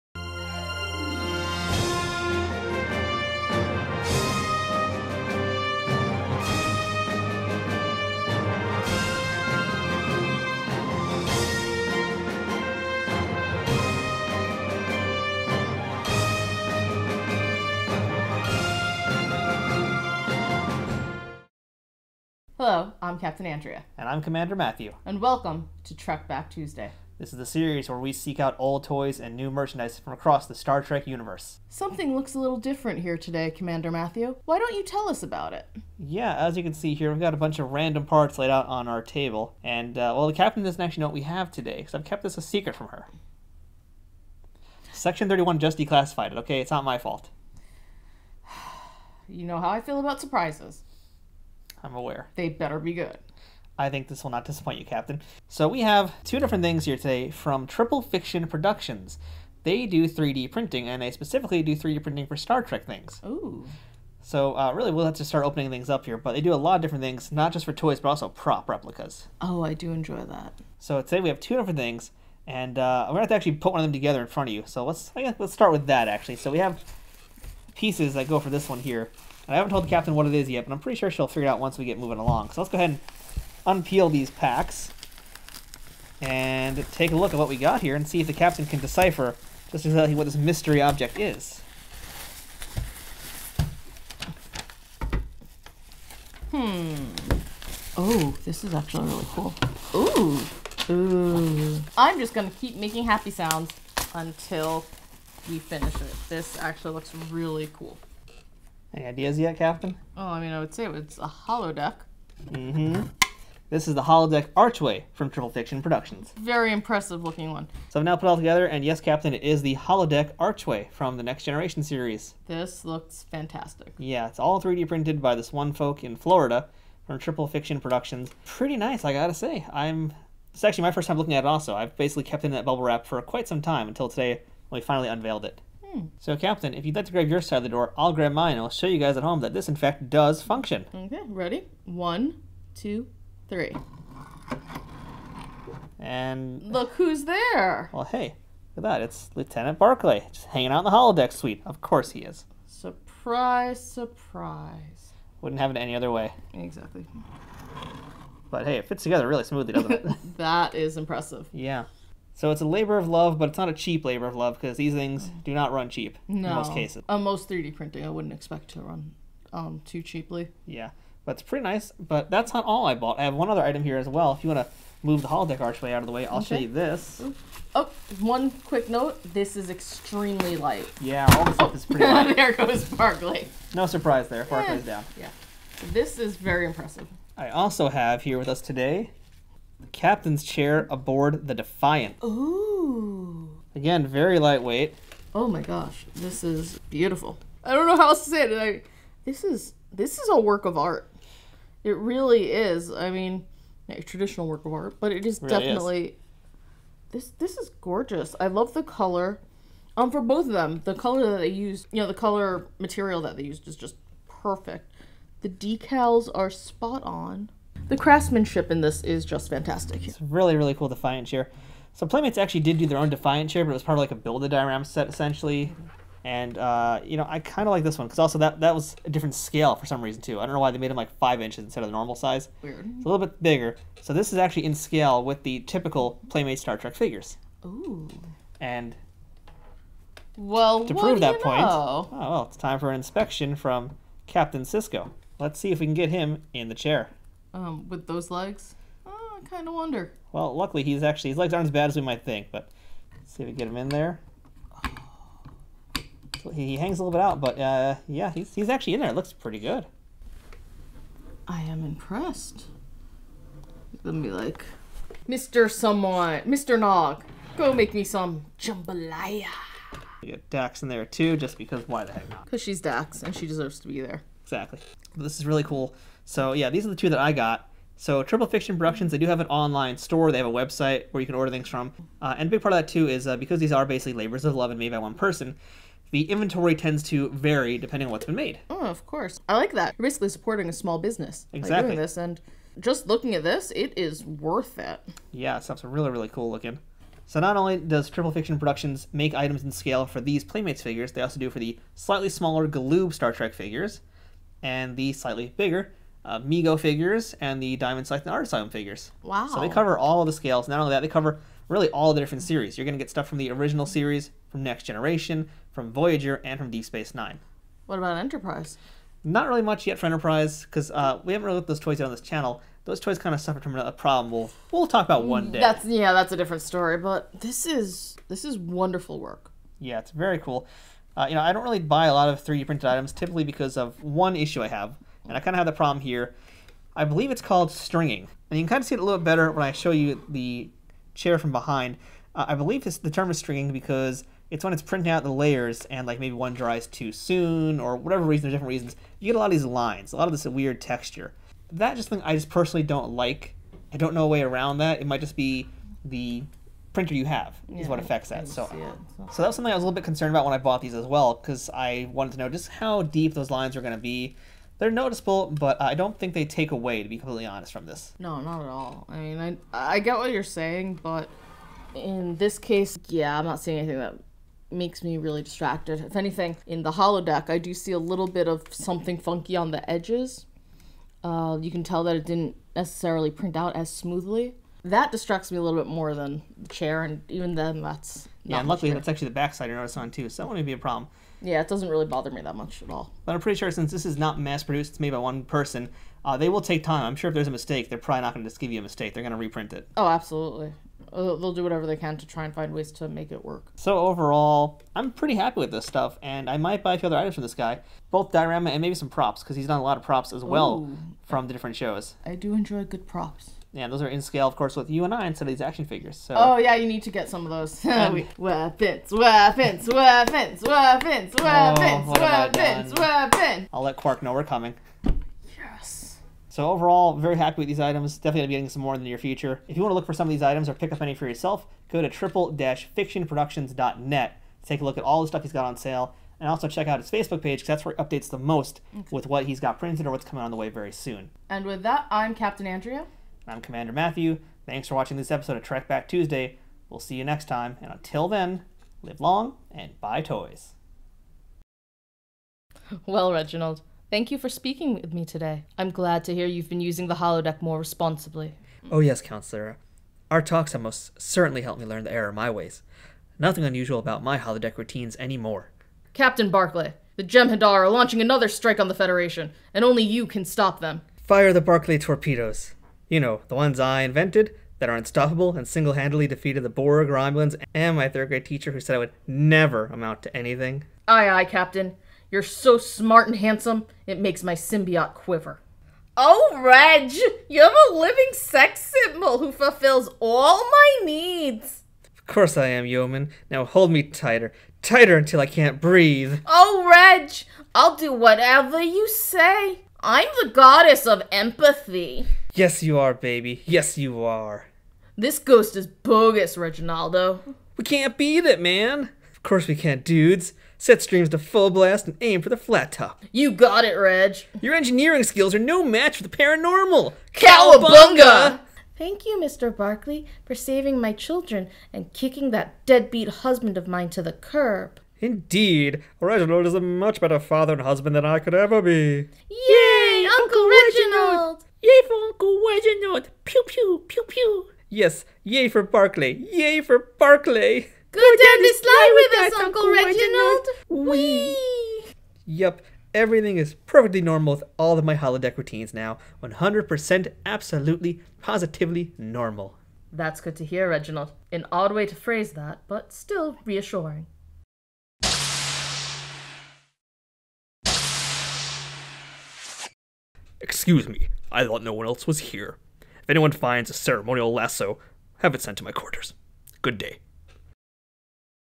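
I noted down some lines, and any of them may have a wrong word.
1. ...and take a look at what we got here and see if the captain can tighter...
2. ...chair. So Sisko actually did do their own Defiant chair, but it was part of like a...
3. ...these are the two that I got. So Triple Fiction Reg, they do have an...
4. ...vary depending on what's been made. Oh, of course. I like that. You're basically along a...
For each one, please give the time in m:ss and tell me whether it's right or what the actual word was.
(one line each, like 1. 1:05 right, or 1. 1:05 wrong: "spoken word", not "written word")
1. 1:26 wrong: "decipher", not "tighter"
2. 3:41 wrong: "Playmates", not "Sisko"
3. 4:36 wrong: "Productions", not "Reg"
4. 4:47 wrong: "supporting", not "along".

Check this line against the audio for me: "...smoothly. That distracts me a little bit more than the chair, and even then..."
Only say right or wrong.
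right.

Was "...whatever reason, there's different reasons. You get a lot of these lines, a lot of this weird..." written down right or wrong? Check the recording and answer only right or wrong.
right.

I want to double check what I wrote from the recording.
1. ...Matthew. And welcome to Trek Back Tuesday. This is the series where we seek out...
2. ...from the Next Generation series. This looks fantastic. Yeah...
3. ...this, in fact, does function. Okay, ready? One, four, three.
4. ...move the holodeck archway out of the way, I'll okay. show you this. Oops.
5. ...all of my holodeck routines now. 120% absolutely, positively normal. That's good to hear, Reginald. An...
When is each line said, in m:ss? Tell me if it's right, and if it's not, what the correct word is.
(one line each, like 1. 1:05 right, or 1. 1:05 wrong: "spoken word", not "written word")
1. 0:24 right
2. 2:00 right
3. 2:19 wrong: "two", not "four"
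4. 2:55 right
5. 9:04 wrong: "100", not "120".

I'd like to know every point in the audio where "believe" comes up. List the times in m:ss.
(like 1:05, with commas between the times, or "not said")
5:37, 5:42.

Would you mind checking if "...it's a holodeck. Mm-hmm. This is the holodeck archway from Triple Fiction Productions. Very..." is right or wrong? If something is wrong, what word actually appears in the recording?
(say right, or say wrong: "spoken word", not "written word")
right.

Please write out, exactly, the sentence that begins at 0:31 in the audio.
Something looks a little different here today, Commander Matthew.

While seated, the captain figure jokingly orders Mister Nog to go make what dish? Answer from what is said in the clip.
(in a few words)
jambalaya.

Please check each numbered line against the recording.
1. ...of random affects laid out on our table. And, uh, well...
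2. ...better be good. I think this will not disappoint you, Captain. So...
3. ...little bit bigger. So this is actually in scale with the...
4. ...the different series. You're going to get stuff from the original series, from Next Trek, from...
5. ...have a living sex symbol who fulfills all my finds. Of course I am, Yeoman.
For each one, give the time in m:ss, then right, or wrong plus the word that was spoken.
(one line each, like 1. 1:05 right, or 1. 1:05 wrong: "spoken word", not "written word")
1. 0:37 wrong: "parts", not "affects"
2. 0:52 right
3. 3:53 right
4. 5:12 wrong: "Generation", not "Trek"
5. 8:07 wrong: "needs", not "finds".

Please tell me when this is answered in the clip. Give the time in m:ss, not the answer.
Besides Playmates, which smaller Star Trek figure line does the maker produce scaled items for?
5:02.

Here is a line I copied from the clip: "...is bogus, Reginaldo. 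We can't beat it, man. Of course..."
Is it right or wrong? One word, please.
right.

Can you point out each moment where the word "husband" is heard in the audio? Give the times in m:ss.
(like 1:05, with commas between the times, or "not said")
8:43, 8:47.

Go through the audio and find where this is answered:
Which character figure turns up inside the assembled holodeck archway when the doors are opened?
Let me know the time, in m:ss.
2:29.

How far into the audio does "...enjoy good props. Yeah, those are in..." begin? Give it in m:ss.
6:52.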